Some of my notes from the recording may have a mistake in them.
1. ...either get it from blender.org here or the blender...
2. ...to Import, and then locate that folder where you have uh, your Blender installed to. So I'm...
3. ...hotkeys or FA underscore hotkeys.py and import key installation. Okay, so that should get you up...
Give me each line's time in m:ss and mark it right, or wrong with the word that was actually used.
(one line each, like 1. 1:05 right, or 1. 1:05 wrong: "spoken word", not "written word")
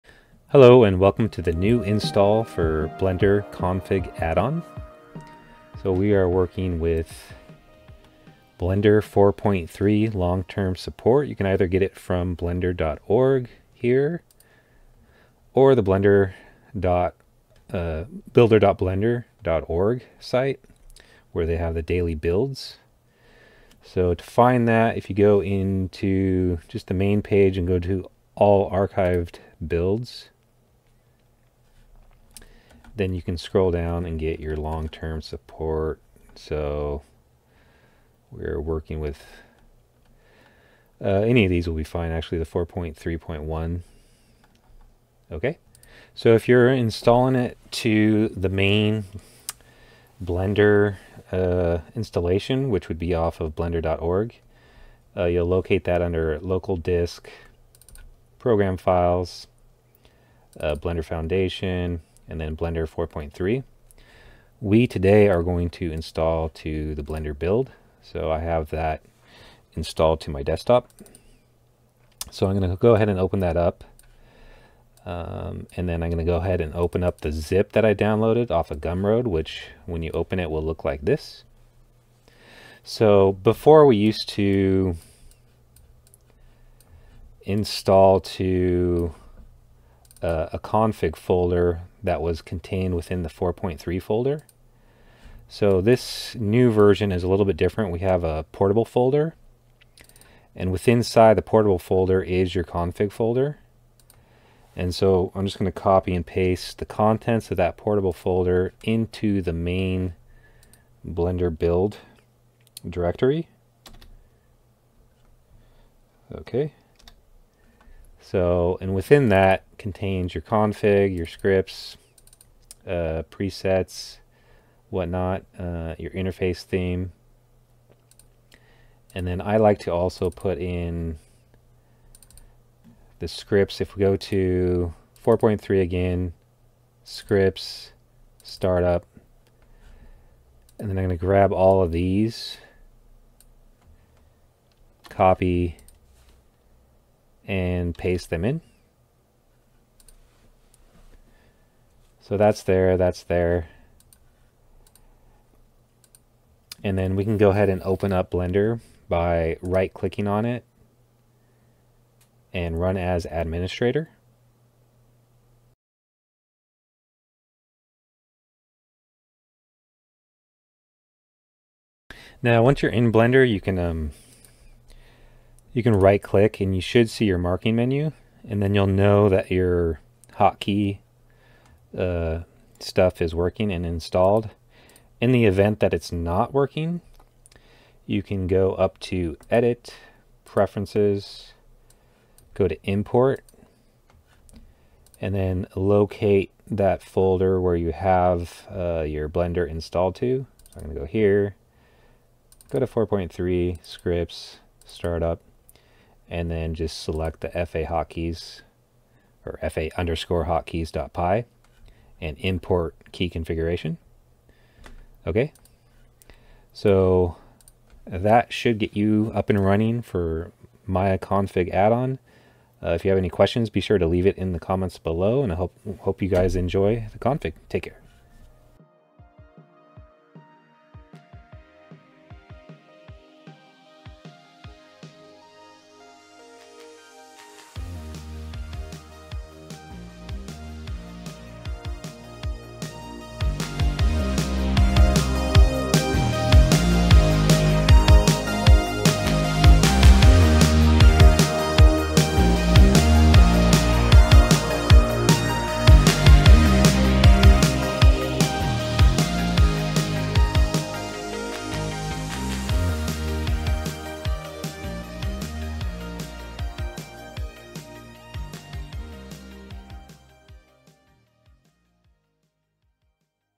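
1. 0:11 right
2. 3:12 right
3. 3:27 wrong: "configuration", not "installation".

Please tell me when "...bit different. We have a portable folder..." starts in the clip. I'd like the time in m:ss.
1:37.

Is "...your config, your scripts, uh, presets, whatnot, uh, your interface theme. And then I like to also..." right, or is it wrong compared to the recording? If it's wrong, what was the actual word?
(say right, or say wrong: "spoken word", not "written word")
right.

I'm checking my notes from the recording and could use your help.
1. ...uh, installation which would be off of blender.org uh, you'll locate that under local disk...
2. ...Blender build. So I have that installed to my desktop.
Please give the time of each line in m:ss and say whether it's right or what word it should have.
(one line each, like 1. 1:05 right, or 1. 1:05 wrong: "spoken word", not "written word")
1. 0:51 right
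2. 1:07 right.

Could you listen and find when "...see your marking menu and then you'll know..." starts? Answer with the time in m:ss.
2:57.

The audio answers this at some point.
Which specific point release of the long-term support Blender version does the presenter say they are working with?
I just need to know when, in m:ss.
0:42.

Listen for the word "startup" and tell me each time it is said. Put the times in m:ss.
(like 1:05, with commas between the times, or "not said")
2:18, 3:24.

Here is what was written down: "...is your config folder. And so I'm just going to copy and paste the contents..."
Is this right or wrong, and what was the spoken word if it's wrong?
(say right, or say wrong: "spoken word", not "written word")
right.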